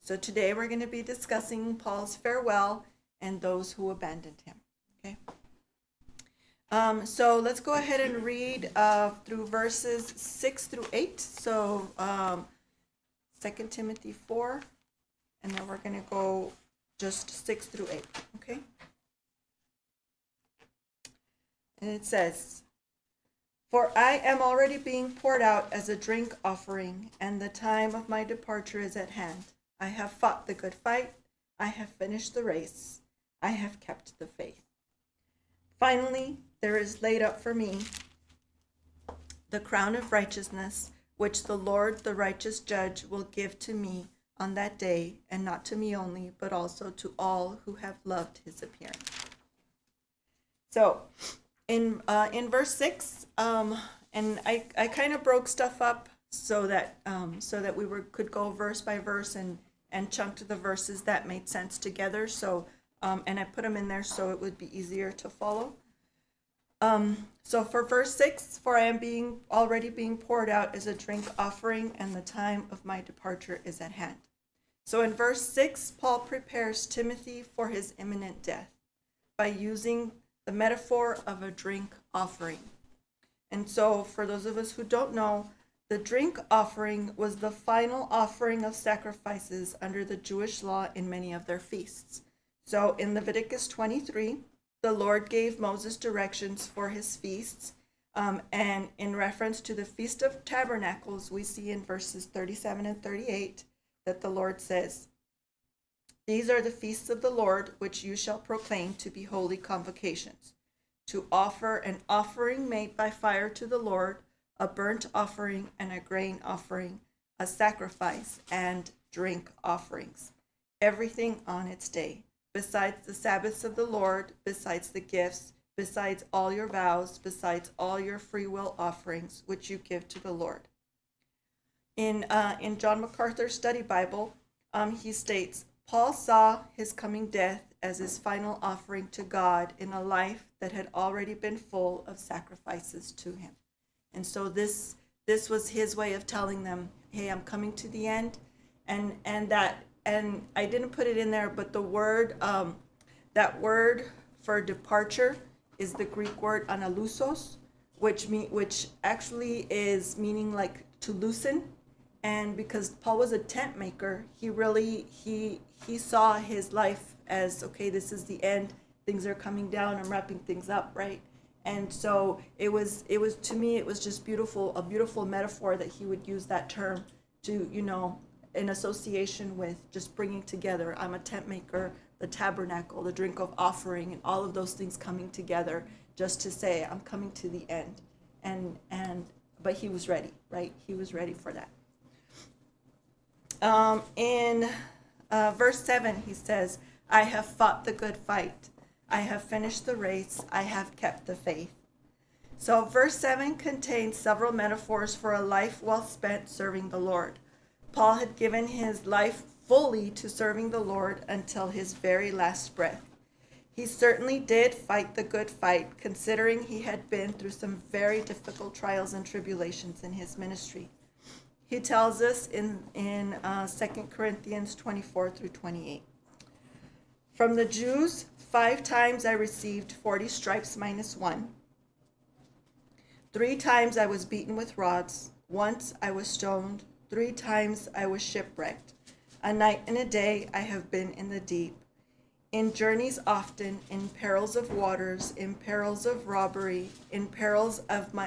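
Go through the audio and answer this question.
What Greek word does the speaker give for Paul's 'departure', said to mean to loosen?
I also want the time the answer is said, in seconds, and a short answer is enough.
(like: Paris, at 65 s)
analusos, at 156 s.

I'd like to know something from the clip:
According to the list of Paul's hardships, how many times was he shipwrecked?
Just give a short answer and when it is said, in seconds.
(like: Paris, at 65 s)
3, at 237 s.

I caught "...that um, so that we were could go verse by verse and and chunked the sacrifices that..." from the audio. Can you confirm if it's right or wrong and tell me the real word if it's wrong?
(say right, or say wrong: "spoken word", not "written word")
wrong: "verses", not "sacrifices".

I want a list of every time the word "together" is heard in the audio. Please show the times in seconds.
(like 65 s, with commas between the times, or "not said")
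61 s, 180 s, 185 s.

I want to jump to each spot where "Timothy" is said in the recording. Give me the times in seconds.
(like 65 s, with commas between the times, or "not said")
13 s, 76 s.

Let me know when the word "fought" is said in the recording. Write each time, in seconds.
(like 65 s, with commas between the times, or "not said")
30 s, 197 s.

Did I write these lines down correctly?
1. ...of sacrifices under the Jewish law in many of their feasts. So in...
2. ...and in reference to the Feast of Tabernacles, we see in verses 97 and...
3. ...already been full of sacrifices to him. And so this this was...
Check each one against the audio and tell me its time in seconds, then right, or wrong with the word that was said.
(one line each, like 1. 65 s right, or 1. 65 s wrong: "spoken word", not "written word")
1. 88 s right
2. 98 s wrong: "37", not "97"
3. 140 s right.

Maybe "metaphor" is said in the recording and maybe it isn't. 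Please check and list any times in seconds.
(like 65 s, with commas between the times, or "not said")
80 s, 175 s, 204 s.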